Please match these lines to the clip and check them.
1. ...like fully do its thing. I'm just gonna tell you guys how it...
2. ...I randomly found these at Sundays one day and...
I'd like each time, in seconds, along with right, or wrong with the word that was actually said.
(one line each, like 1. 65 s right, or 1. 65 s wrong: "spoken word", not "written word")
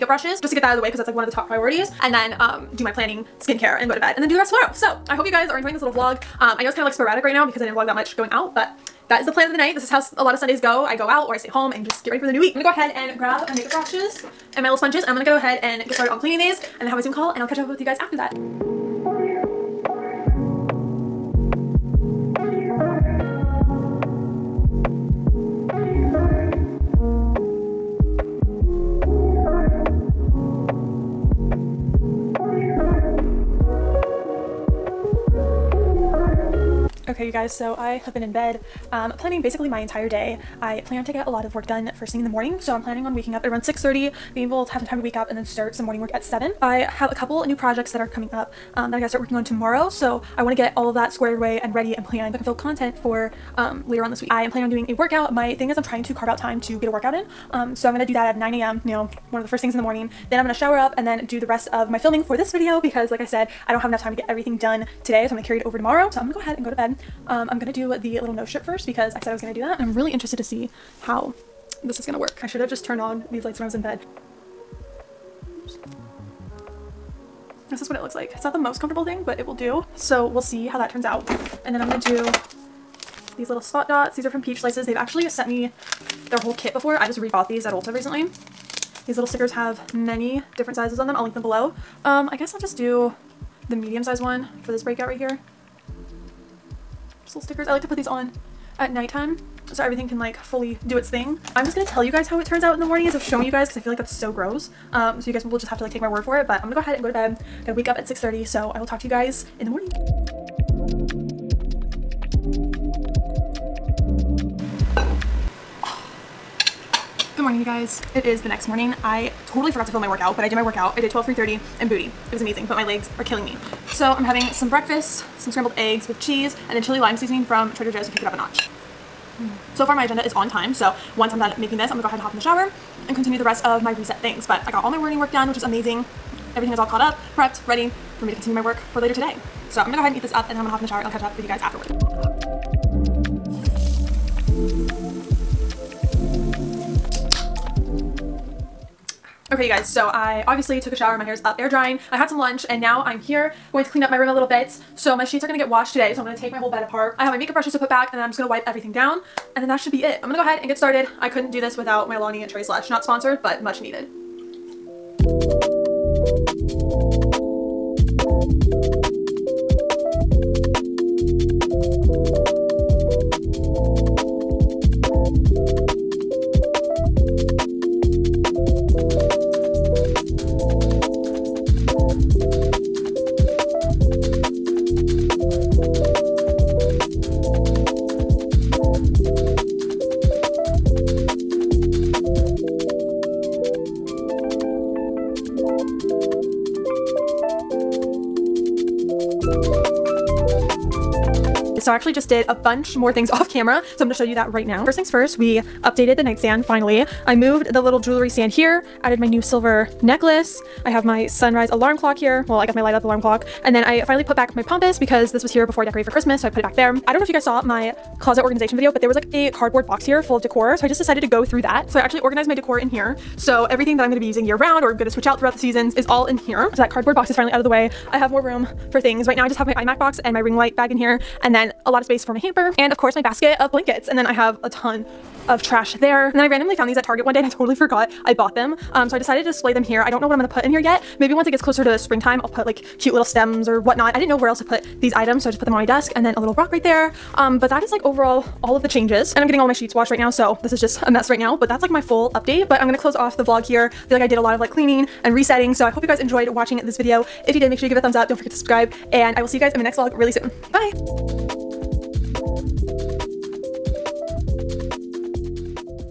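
1. 100 s right
2. 236 s wrong: "Target", not "Sundays".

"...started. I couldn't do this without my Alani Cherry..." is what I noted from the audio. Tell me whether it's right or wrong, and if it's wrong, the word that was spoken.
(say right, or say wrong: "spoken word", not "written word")
right.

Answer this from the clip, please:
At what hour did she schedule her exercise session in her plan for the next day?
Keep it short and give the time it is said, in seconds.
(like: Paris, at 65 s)
9 a.m., at 58 s.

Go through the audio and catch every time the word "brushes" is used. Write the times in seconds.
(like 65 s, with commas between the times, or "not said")
0 s, 13 s, 157 s.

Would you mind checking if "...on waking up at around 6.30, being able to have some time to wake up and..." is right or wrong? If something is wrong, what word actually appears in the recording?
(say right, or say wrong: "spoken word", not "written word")
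right.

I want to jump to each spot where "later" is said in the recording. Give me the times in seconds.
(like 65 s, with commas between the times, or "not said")
53 s, 138 s.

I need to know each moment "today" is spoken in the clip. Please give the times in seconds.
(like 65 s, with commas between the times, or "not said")
65 s, 139 s, 155 s.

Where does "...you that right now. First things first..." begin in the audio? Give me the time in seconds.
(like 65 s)
204 s.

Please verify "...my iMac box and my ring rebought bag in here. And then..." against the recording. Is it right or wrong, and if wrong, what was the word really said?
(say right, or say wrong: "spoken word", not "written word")
wrong: "light", not "rebought".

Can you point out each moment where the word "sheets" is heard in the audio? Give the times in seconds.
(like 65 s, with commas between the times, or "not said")
155 s, 249 s.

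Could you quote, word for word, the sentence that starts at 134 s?
But I got all my morning work done, which is amazing.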